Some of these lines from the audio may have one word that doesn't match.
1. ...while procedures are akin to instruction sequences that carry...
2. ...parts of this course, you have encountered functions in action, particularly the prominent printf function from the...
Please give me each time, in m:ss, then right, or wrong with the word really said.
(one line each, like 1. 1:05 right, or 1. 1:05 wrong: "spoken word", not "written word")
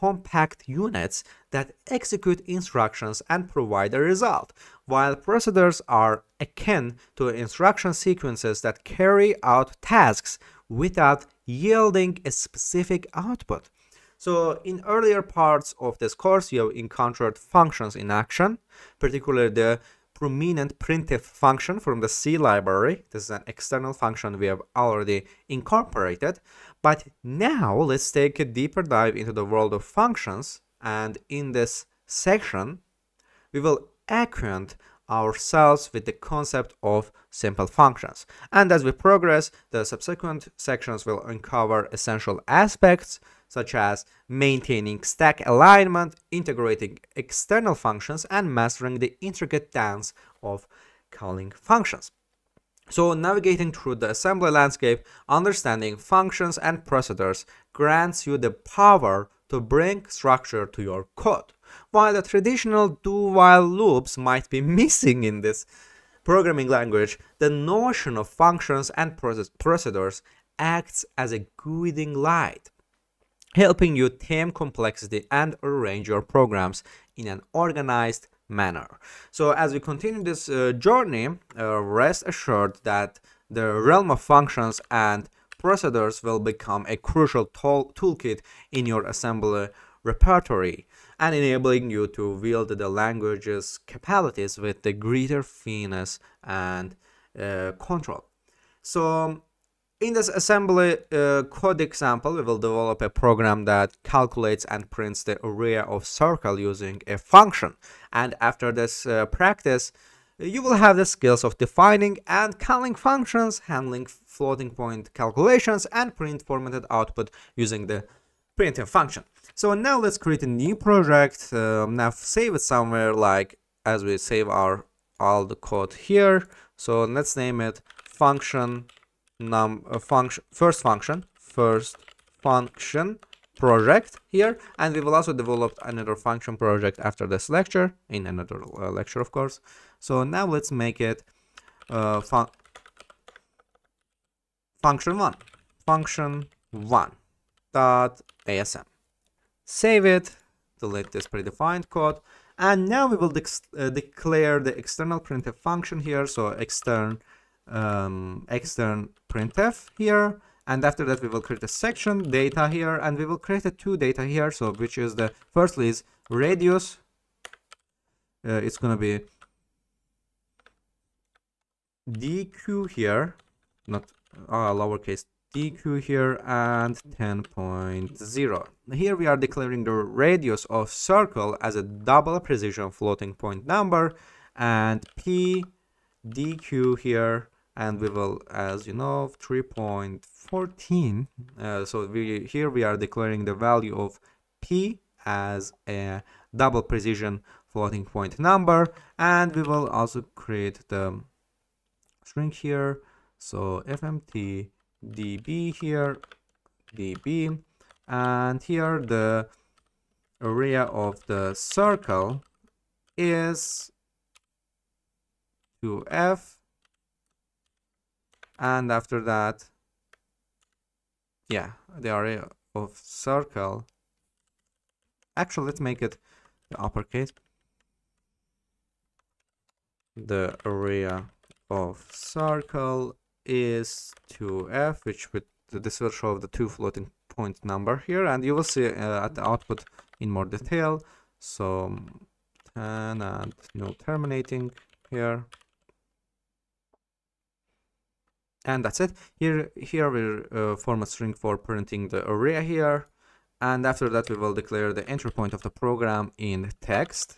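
1. 0:04 right
2. 0:15 right.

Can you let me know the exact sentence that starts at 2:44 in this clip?
So which is the firstly is radius.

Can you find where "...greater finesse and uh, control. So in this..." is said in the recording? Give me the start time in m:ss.
1:34.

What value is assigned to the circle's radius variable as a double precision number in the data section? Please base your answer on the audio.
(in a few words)
10.0.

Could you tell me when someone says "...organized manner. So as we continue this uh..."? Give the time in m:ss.
1:17.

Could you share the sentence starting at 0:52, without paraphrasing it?
So navigating through the assembly landscape, understanding functions and procedures grants you the power to bring structure to your code.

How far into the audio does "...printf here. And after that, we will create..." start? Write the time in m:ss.
2:39.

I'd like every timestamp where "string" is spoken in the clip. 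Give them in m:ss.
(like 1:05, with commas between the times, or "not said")
3:22, 4:11.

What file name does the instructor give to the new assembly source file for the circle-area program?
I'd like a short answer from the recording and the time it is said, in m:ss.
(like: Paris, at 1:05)
function1.asm, at 2:25.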